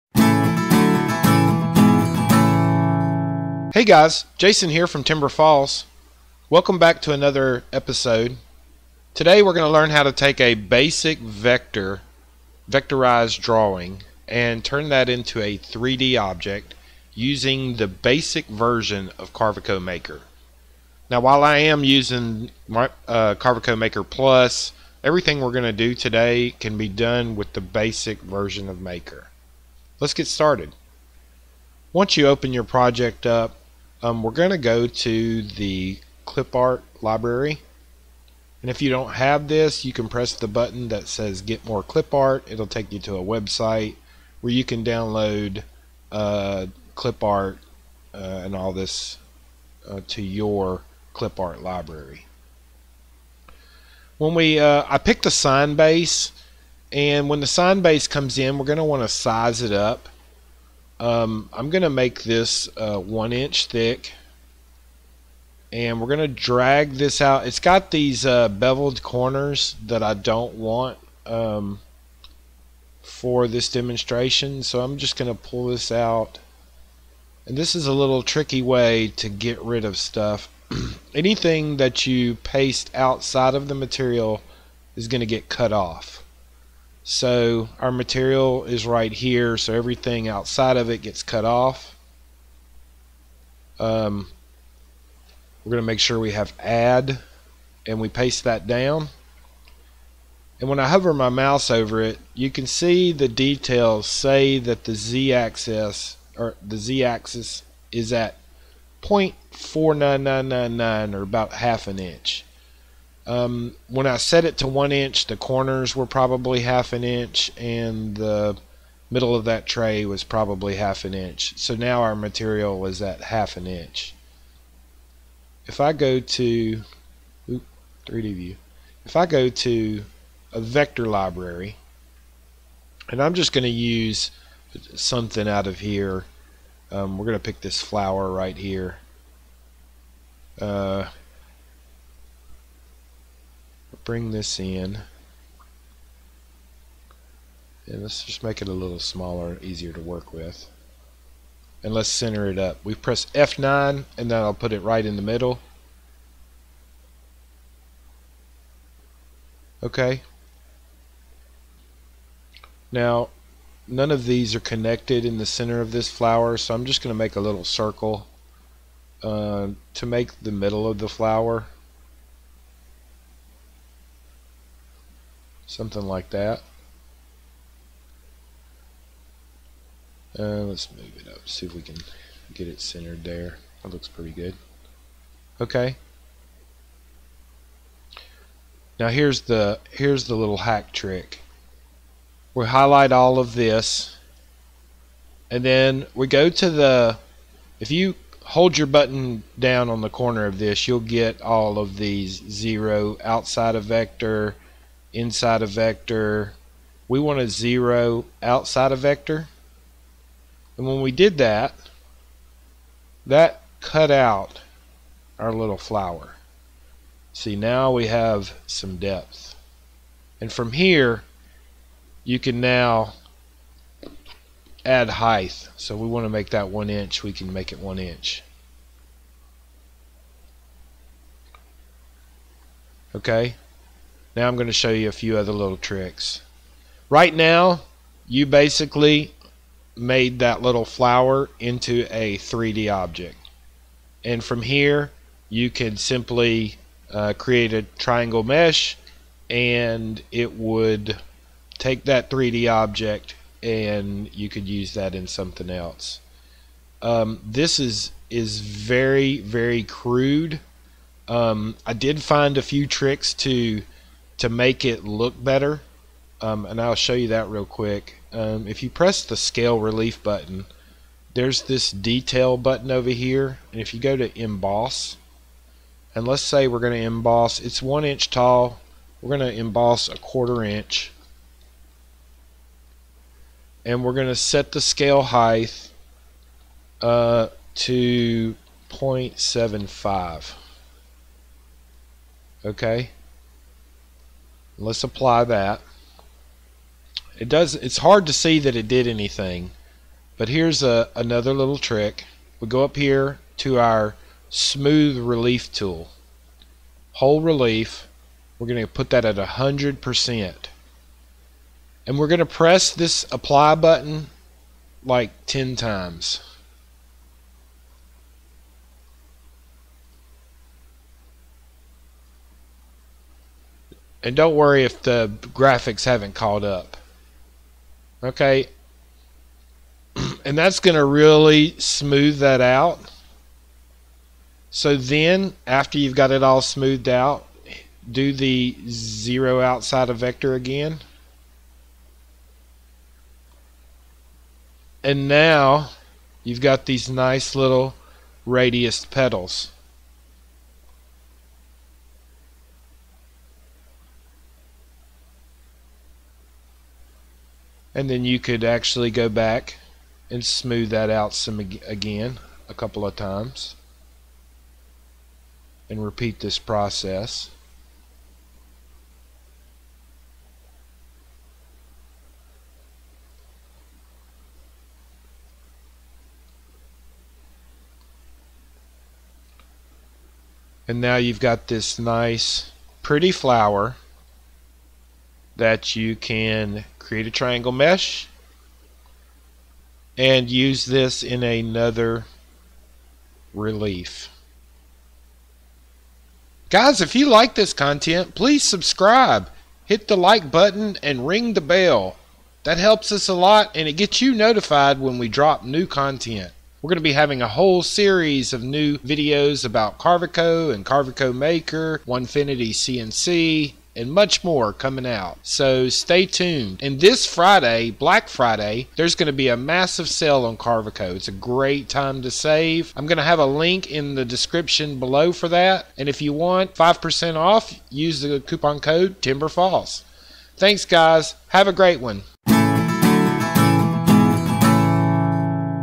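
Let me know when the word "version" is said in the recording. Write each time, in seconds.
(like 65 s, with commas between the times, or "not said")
18 s, 28 s.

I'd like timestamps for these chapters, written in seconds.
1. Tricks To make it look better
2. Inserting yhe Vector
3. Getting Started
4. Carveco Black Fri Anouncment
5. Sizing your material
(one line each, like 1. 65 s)
1. 263 s
2. 157 s
3. 38 s
4. 399 s
5. 86 s.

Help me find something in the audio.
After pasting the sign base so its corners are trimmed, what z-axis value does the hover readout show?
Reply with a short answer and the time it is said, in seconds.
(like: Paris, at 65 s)
0.49999, at 109 s.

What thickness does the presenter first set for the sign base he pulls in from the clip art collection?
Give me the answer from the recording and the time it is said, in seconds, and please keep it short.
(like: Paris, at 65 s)
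1 inch, at 62 s.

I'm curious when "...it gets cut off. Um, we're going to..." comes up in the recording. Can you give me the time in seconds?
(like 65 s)
90 s.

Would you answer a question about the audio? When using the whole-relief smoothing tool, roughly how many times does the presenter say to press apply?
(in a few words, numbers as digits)
10.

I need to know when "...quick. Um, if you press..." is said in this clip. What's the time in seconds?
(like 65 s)
267 s.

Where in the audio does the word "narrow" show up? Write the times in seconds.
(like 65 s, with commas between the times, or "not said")
not said.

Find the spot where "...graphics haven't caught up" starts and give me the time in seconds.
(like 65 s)
325 s.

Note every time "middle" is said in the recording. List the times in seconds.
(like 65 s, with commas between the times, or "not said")
119 s, 155 s, 170 s.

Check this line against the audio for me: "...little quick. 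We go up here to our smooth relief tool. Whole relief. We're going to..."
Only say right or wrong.
wrong.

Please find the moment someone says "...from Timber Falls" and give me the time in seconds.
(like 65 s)
4 s.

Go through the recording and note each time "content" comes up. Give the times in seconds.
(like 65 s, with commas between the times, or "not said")
397 s, 405 s.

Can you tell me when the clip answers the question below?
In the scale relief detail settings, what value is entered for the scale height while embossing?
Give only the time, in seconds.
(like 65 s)
288 s.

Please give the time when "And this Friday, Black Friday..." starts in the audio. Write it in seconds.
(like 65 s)
416 s.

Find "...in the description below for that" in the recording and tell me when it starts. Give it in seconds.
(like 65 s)
423 s.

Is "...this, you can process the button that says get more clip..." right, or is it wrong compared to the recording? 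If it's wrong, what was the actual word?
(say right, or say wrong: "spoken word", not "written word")
wrong: "press", not "process".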